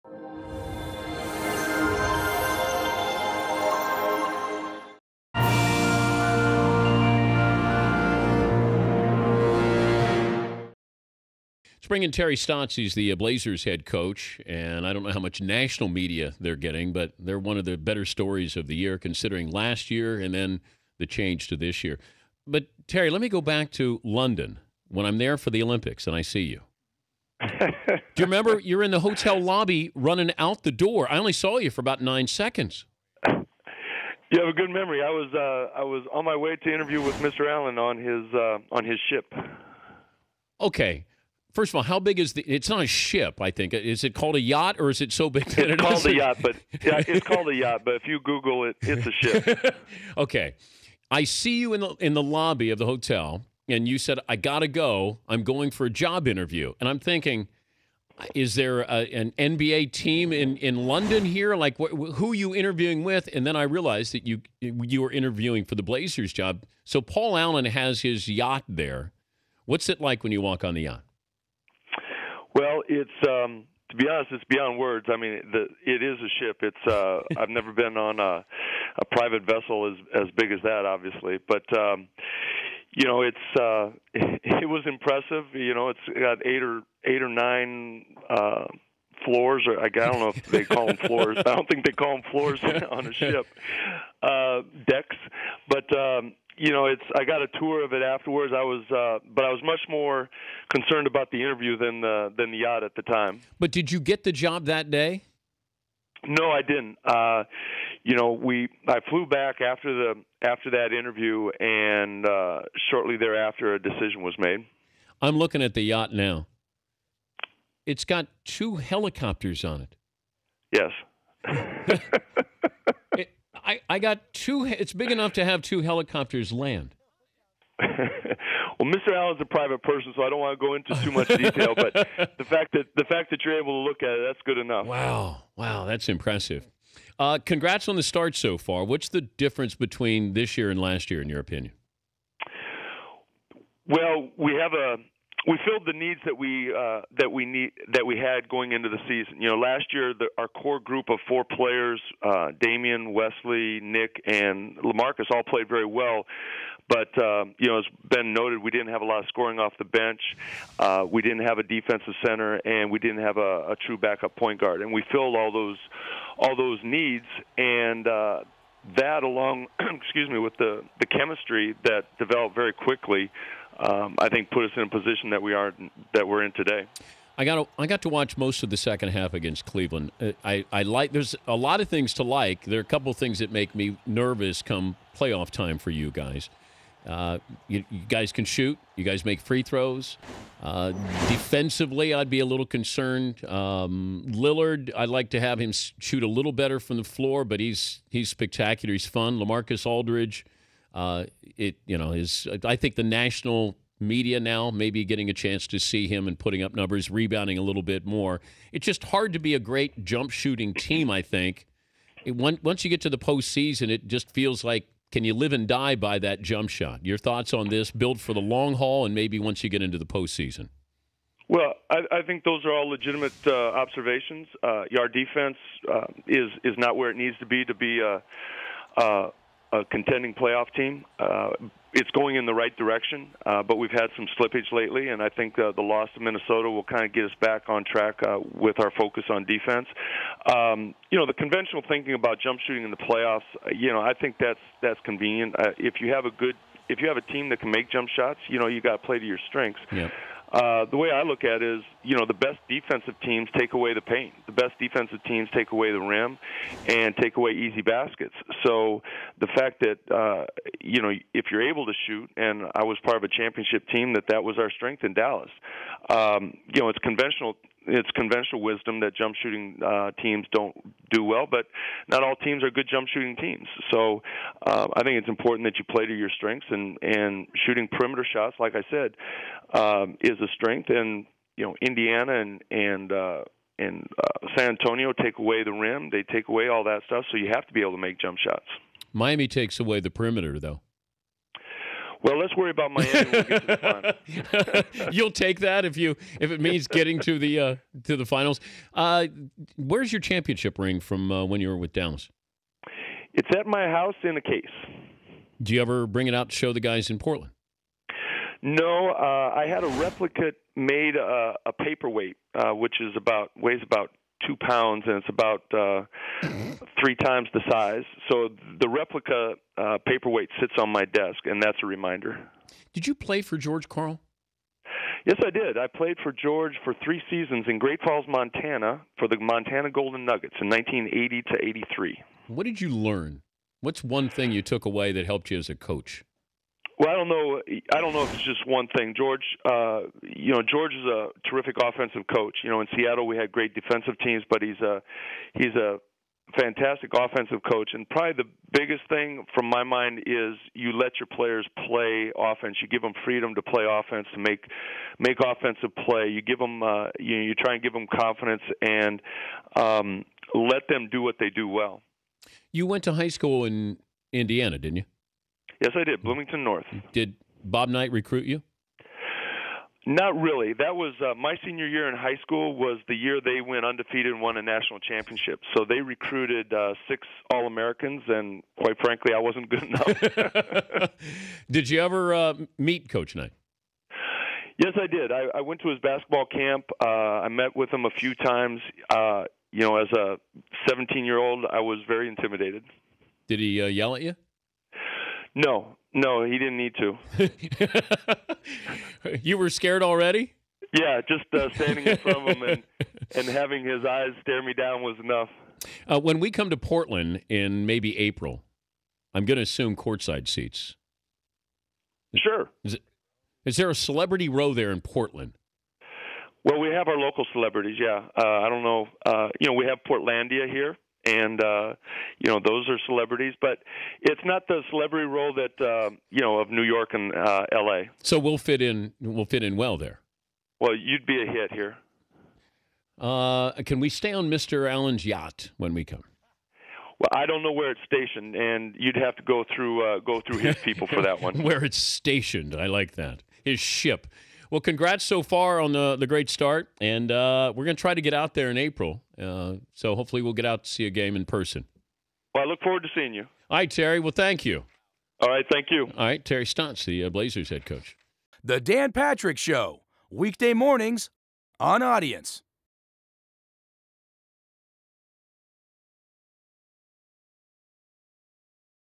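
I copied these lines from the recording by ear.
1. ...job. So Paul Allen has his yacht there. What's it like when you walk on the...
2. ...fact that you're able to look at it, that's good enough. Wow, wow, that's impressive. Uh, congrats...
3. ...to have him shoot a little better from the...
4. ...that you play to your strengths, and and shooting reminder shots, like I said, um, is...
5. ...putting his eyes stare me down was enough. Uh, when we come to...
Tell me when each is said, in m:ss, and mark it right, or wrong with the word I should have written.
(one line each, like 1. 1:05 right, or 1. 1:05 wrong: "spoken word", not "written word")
1. 1:06 right
2. 2:13 right
3. 3:15 right
4. 4:35 wrong: "perimeter", not "reminder"
5. 6:43 wrong: "having", not "putting".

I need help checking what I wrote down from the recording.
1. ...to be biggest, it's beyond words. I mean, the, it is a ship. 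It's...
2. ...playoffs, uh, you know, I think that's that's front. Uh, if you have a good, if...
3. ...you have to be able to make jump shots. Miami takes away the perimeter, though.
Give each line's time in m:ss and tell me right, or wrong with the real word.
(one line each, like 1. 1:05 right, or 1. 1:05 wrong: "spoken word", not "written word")
1. 1:13 wrong: "honest", not "biggest"
2. 4:02 wrong: "convenient", not "front"
3. 4:47 right.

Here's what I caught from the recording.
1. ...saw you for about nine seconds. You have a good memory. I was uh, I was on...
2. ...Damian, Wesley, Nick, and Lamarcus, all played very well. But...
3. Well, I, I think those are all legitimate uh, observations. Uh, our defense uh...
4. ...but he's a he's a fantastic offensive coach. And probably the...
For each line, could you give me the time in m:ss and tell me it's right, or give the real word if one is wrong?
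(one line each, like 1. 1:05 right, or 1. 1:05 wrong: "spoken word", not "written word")
1. 0:31 right
2. 2:32 right
3. 3:41 right
4. 5:44 right.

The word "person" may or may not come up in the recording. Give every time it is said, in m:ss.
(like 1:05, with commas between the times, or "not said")
2:09, 7:31.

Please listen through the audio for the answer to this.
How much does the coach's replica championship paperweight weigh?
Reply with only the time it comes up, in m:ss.
5:13.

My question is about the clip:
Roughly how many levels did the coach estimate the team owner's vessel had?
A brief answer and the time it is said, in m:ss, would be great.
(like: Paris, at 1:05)
8 or 9, at 1:26.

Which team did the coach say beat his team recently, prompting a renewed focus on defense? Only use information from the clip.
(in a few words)
Minnesota.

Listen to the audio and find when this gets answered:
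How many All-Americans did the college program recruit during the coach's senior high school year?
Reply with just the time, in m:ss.
6:17.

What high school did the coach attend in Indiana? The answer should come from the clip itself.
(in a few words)
Bloomington North.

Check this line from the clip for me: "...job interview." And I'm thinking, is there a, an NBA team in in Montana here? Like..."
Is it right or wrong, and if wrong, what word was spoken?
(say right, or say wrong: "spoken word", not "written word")
wrong: "London", not "Montana".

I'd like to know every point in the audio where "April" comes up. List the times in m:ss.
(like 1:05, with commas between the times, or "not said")
6:48, 7:28.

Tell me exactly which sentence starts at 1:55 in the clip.
I'm looking at the yacht now.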